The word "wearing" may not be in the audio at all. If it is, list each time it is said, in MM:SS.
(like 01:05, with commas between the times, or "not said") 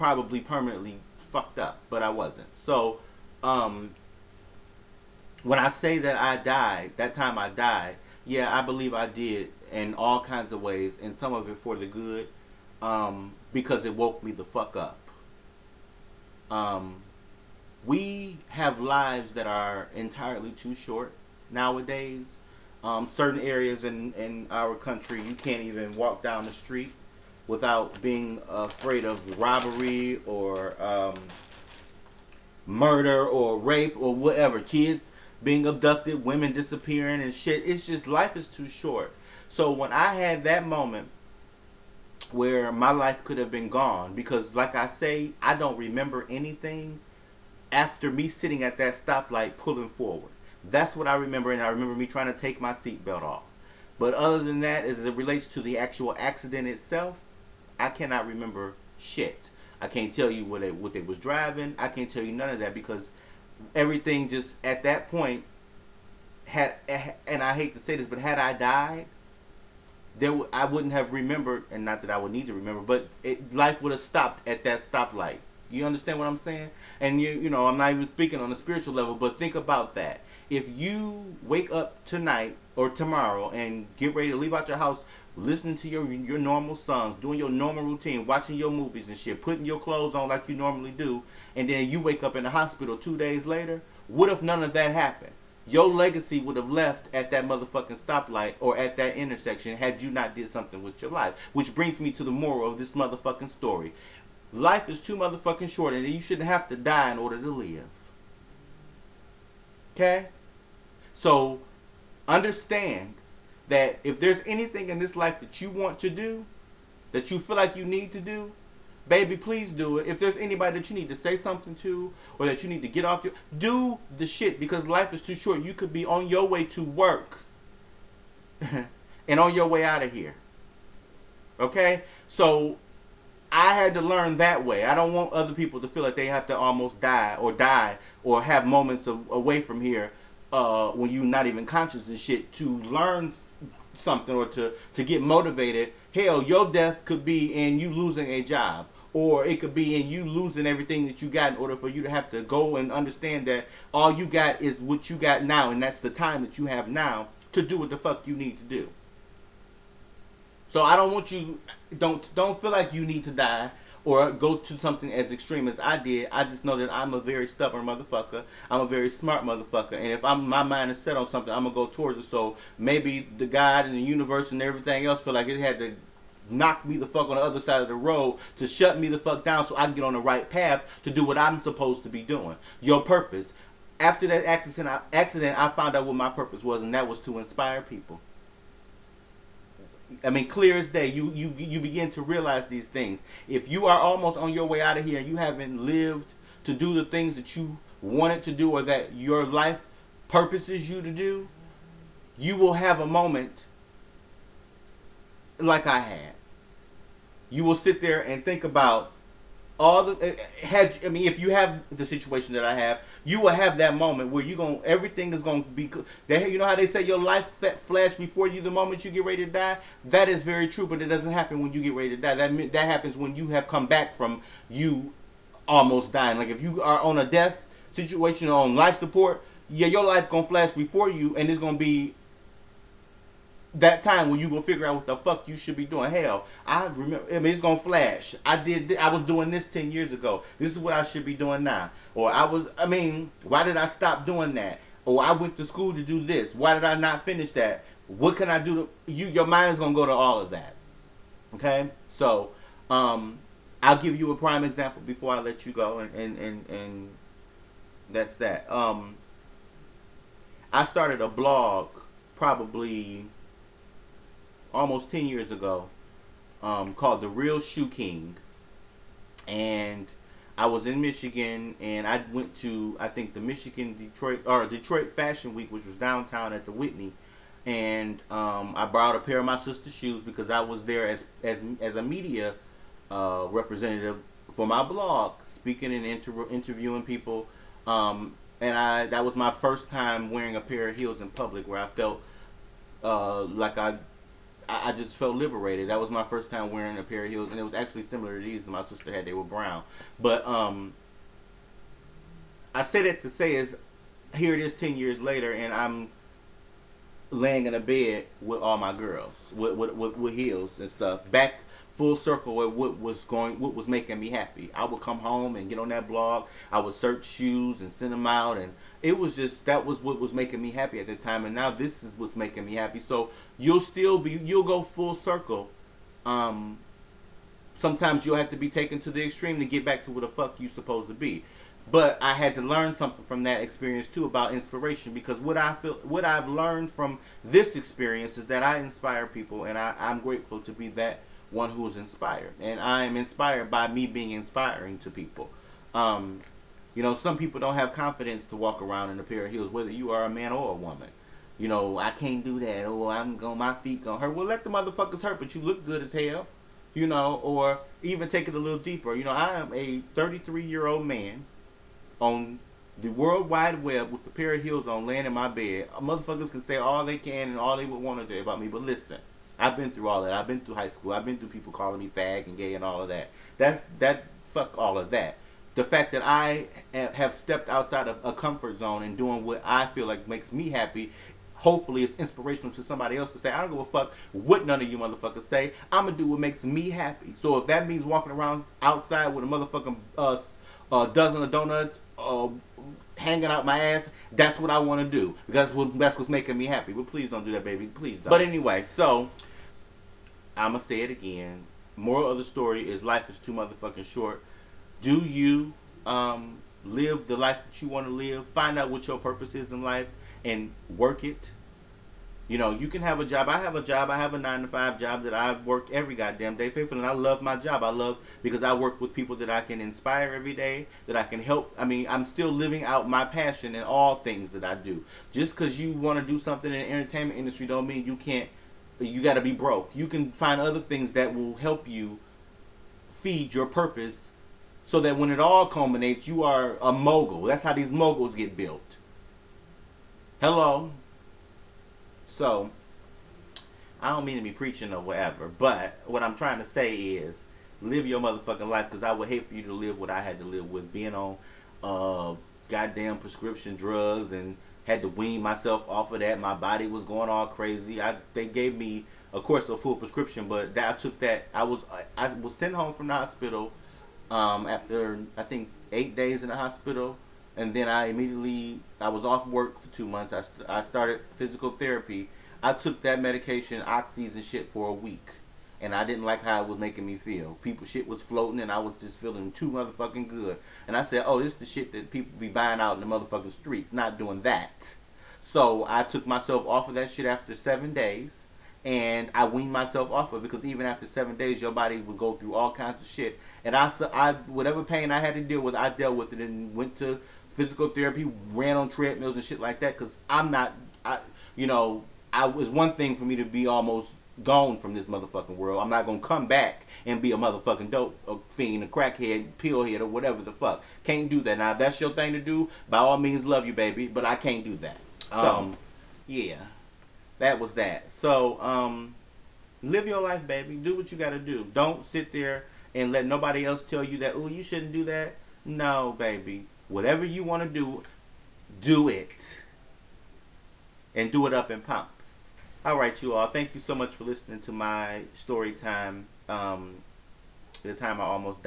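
04:50, 04:56.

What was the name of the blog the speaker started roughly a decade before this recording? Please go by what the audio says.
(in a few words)
The Real Shoe King.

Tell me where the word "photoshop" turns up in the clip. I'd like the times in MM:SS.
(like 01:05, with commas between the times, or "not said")
not said.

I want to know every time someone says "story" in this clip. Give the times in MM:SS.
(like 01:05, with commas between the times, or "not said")
01:43, 06:42, 08:55.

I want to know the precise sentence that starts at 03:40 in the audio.
That is very true, but it doesn't happen when you get ready to die.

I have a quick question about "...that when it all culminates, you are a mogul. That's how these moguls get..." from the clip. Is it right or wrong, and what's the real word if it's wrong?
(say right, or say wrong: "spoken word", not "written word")
right.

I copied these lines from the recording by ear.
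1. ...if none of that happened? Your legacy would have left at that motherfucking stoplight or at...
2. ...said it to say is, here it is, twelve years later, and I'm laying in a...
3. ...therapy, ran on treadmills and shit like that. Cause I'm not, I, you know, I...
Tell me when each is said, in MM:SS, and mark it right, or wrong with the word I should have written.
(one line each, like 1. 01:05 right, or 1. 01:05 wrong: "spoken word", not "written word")
1. 01:34 right
2. 05:02 wrong: "ten", not "twelve"
3. 08:17 right.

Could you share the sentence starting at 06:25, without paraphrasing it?
I'm gonna do what makes me happy.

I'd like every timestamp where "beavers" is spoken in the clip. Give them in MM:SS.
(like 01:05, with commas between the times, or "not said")
not said.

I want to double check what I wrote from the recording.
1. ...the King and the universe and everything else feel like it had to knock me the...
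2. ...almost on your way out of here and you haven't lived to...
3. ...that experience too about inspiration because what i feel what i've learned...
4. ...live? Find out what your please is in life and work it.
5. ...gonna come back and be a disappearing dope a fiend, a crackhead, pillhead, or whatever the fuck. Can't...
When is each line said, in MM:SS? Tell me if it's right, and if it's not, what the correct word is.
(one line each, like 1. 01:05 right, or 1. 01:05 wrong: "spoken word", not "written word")
1. 02:53 wrong: "God", not "King"
2. 03:13 right
3. 05:33 right
4. 06:48 wrong: "purpose", not "please"
5. 08:26 wrong: "motherfucking", not "disappearing".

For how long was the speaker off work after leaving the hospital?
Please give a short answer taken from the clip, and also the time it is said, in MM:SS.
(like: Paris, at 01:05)
2 months, at 07:49.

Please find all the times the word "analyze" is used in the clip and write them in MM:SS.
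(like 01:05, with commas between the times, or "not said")
not said.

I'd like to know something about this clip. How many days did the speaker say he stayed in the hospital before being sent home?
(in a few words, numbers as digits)
8.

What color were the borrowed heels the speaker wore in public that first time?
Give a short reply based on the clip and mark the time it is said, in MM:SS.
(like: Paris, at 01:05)
Brown, at 04:59.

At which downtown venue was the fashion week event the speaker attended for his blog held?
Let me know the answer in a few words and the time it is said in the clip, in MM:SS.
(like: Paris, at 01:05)
The Whitney, at 04:36.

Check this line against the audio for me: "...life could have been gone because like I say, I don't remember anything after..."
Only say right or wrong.
right.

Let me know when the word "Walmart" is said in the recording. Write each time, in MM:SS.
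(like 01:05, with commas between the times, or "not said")
not said.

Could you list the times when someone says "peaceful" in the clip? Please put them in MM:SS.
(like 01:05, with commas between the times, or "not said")
not said.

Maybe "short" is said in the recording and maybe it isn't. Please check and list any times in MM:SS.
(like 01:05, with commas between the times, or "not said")
00:20, 00:38, 01:45, 02:05, 06:44.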